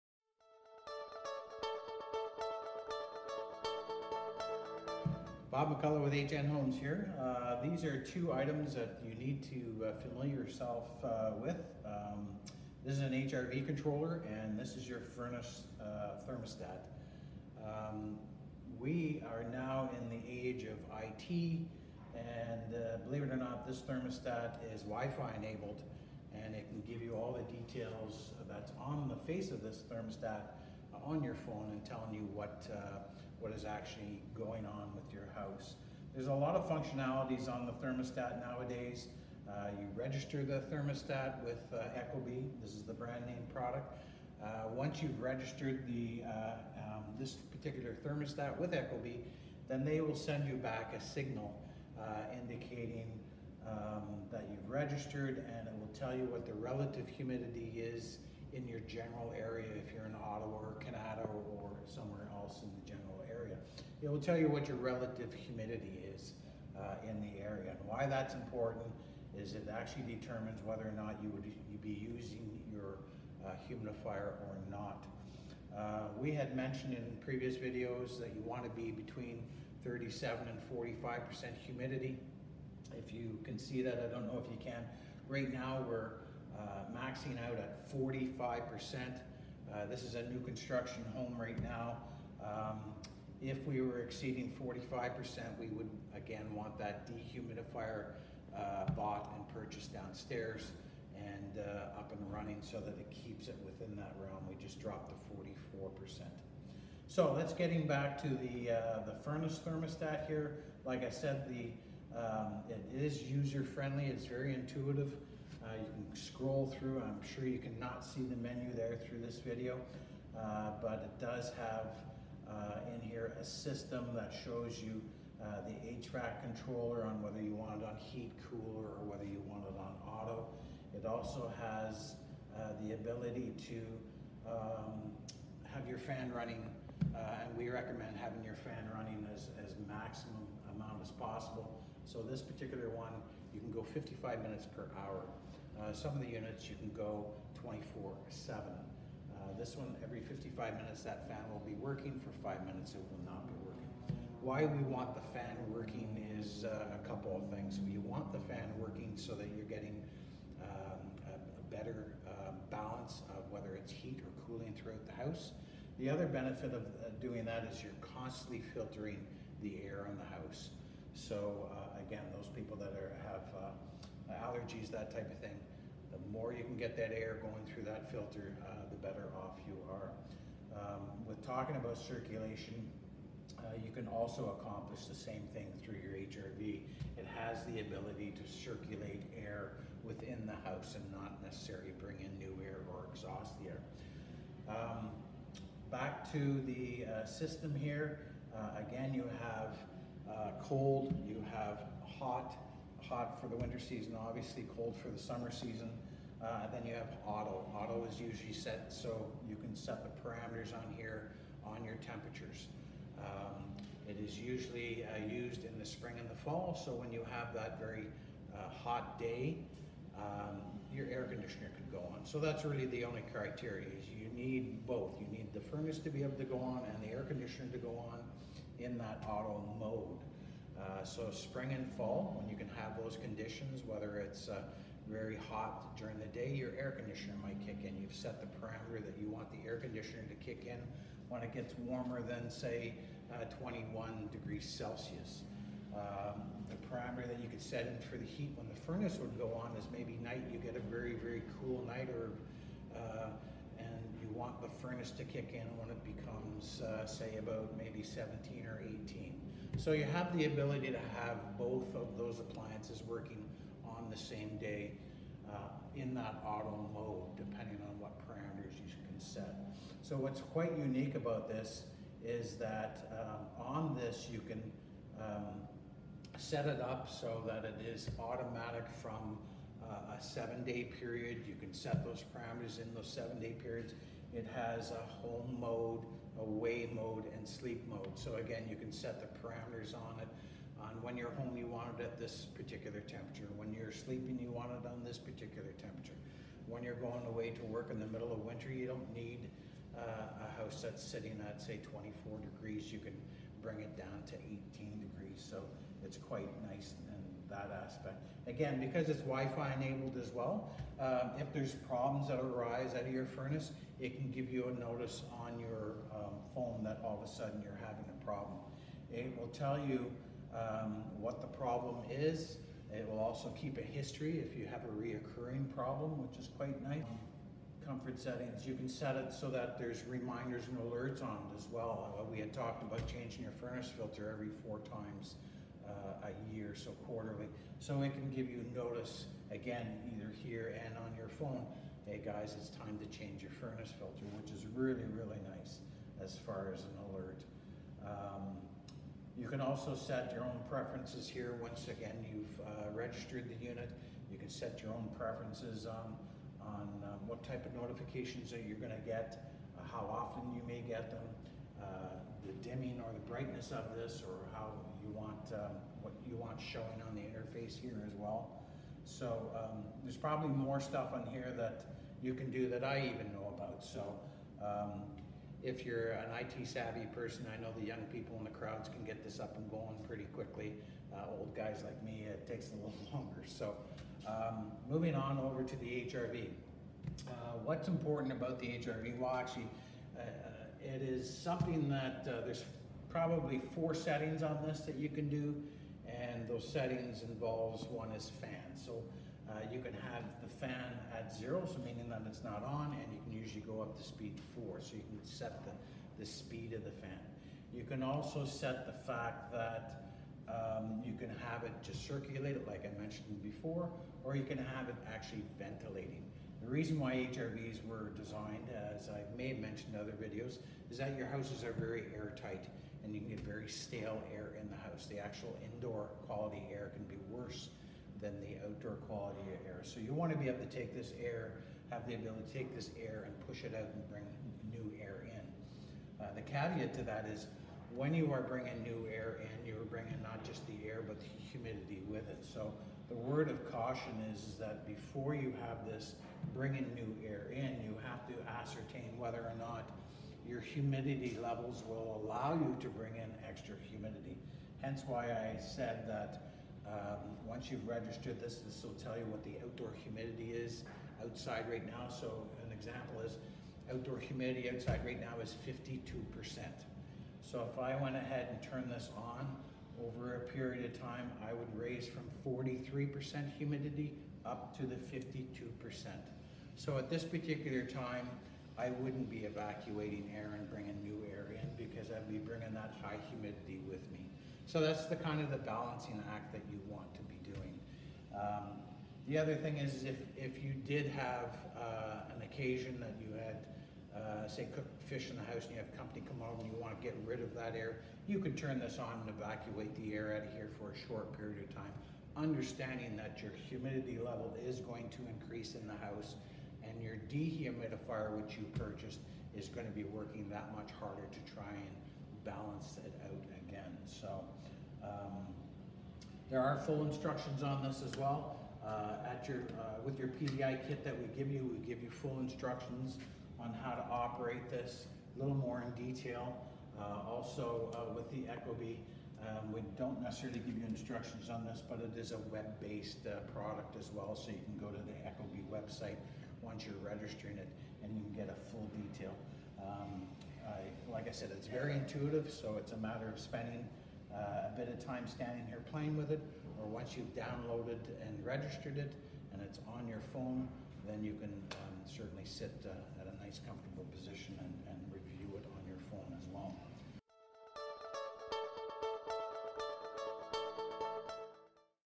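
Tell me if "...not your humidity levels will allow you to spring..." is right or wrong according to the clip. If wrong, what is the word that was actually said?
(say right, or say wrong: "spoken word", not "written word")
wrong: "bring", not "spring".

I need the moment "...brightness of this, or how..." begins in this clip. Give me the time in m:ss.
6:03.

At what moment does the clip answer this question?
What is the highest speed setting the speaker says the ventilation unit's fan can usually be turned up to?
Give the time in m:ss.
6:44.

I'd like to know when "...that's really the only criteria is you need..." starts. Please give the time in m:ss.
3:42.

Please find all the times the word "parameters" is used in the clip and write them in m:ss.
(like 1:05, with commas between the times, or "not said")
3:30, 3:58, 4:06, 4:28, 4:42, 4:49.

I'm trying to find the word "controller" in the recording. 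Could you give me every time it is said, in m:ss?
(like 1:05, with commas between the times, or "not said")
0:13, 2:06.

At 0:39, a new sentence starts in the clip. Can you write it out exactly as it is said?
Uh, you register the thermostat with uh, Ecobee.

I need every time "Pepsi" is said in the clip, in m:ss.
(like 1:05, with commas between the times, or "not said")
not said.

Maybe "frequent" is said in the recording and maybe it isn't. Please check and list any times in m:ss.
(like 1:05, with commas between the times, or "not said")
not said.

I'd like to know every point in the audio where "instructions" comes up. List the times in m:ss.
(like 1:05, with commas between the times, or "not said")
8:37, 8:42, 8:50.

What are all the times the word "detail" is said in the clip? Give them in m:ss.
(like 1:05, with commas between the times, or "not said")
0:27, 8:46, 8:59.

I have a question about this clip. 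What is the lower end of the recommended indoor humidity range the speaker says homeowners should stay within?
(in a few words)
37%.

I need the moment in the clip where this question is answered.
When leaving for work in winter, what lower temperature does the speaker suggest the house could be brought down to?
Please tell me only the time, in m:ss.
5:04.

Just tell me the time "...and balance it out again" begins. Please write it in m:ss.
8:31.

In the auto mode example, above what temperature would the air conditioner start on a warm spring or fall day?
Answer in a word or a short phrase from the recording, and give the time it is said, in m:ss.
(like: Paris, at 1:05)
21 degrees Celsius, at 4:03.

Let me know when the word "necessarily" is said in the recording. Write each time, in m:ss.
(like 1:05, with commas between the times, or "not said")
3:11, 8:50.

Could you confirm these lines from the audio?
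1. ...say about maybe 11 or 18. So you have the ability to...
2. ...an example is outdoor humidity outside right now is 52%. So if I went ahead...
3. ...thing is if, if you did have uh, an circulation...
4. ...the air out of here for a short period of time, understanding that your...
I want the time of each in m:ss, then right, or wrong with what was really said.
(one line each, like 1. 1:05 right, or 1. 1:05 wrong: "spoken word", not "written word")
1. 4:17 wrong: "17", not "11"
2. 7:42 right
3. 8:09 wrong: "occasion", not "circulation"
4. 8:19 right.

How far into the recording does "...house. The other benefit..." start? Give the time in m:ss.
2:45.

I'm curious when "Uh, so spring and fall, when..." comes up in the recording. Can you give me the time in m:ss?
3:50.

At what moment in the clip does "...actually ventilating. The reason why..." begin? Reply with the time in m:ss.
6:55.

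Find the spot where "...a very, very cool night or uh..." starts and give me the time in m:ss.
4:10.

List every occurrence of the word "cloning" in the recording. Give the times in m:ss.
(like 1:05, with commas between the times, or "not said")
not said.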